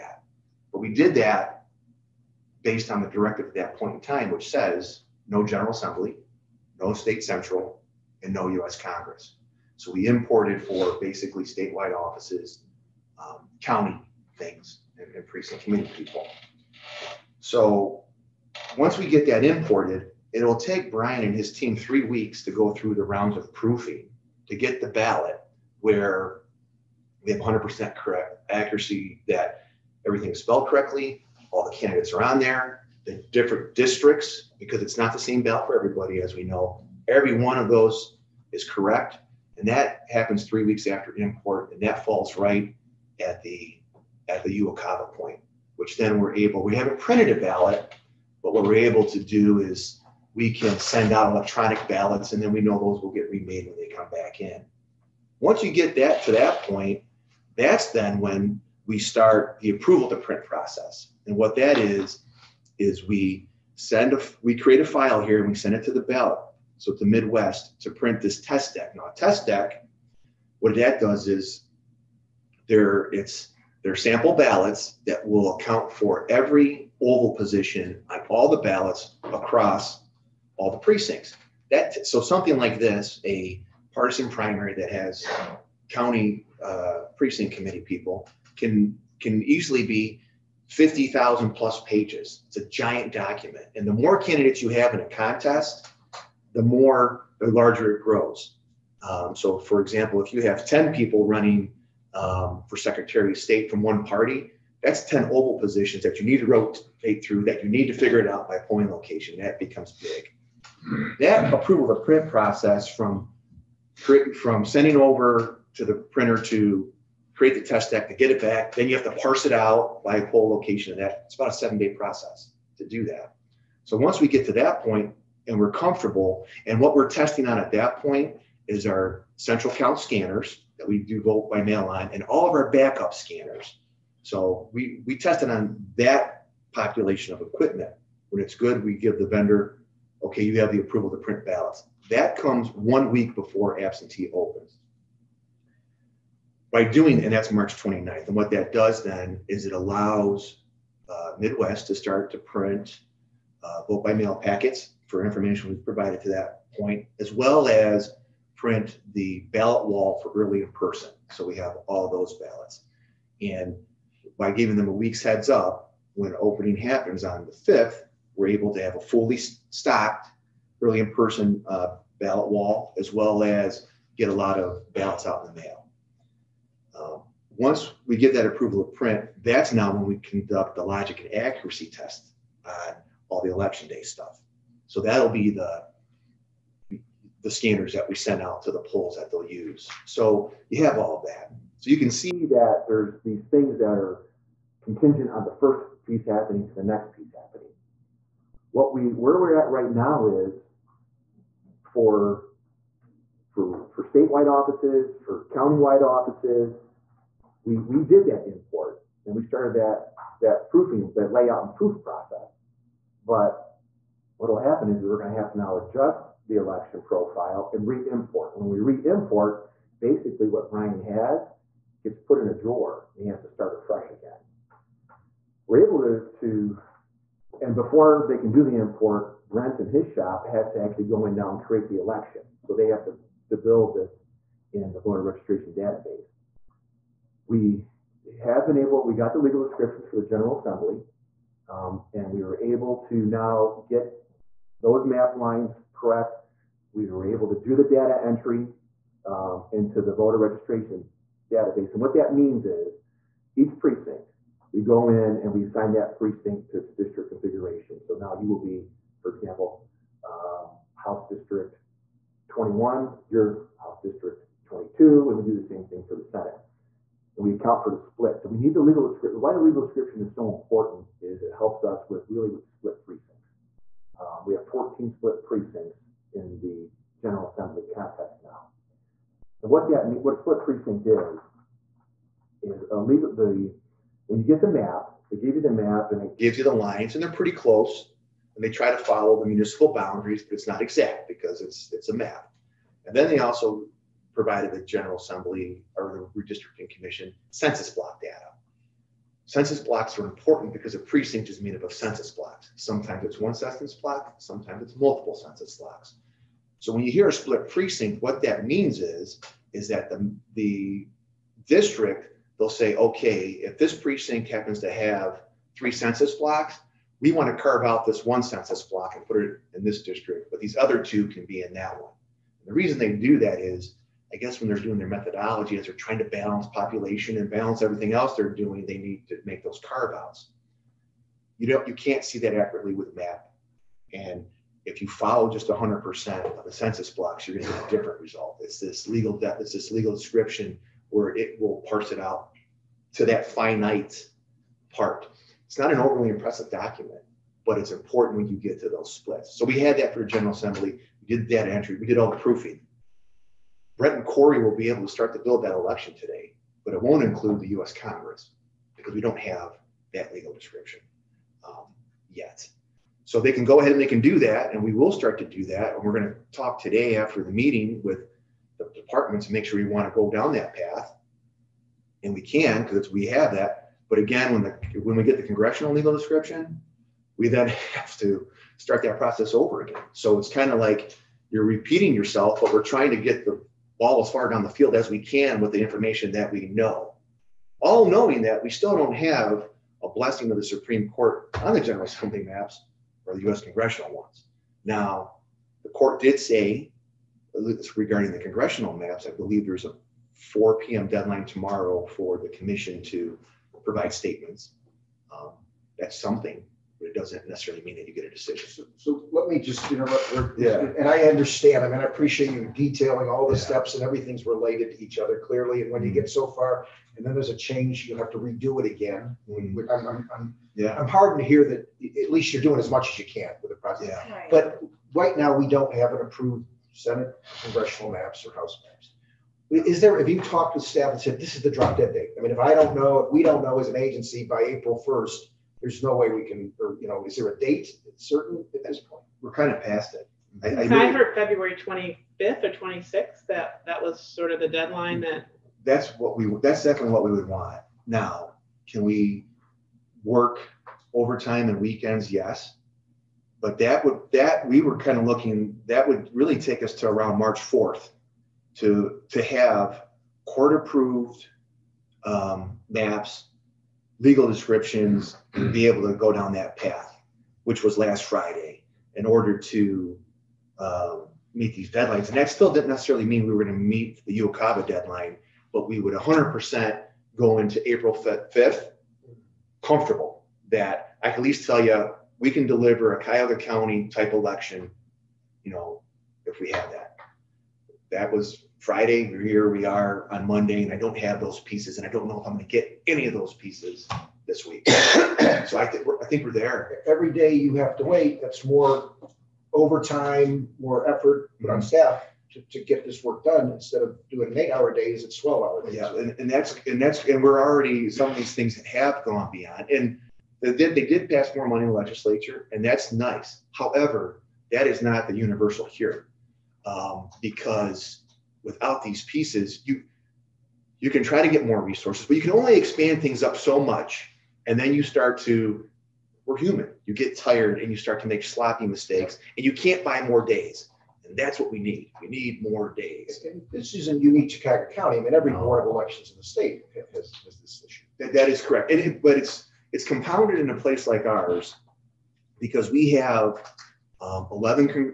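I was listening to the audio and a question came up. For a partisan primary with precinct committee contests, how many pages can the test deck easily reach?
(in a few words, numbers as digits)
50,000 plus.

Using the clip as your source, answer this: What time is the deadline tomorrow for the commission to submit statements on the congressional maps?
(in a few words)
4 p.m.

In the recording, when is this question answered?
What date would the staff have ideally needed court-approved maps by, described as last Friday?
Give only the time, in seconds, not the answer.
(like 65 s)
457 s.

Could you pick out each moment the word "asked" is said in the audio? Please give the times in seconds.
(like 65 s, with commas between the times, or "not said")
not said.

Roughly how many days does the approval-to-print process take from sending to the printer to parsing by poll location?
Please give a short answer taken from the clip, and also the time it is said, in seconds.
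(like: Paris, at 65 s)
7 days, at 121 s.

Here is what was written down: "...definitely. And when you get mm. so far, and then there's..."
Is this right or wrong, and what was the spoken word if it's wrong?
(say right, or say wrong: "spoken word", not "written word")
wrong: "clearly", not "definitely".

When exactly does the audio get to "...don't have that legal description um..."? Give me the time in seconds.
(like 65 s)
359 s.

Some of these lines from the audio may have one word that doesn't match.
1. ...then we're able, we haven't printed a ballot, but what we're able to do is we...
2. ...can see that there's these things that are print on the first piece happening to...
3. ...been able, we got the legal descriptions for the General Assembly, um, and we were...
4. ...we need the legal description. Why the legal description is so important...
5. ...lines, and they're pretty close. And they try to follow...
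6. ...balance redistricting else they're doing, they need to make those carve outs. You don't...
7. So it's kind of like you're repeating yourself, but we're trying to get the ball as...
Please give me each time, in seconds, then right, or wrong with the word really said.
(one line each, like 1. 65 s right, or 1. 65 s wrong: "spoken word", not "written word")
1. 45 s right
2. 191 s wrong: "contingent", not "print"
3. 238 s right
4. 268 s right
5. 286 s right
6. 327 s wrong: "everything", not "redistricting"
7. 380 s right.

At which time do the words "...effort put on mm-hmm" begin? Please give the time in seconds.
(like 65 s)
501 s.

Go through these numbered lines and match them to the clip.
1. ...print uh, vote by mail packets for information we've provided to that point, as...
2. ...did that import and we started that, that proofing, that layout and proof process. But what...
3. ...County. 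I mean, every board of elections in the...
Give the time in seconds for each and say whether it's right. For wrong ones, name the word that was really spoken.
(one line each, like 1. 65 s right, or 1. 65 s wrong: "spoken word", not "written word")
1. 152 s right
2. 208 s right
3. 534 s right.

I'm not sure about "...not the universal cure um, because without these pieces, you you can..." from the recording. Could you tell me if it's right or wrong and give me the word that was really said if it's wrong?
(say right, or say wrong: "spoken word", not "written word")
right.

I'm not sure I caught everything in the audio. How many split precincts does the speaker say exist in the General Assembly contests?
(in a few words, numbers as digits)
14.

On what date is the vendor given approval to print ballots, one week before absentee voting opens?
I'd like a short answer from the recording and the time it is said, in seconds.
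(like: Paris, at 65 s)
March 29th, at 147 s.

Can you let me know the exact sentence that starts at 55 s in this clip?
Once you get that to that point, that's then when we start the approval to print process.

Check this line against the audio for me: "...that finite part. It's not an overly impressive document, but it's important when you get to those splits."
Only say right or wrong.
right.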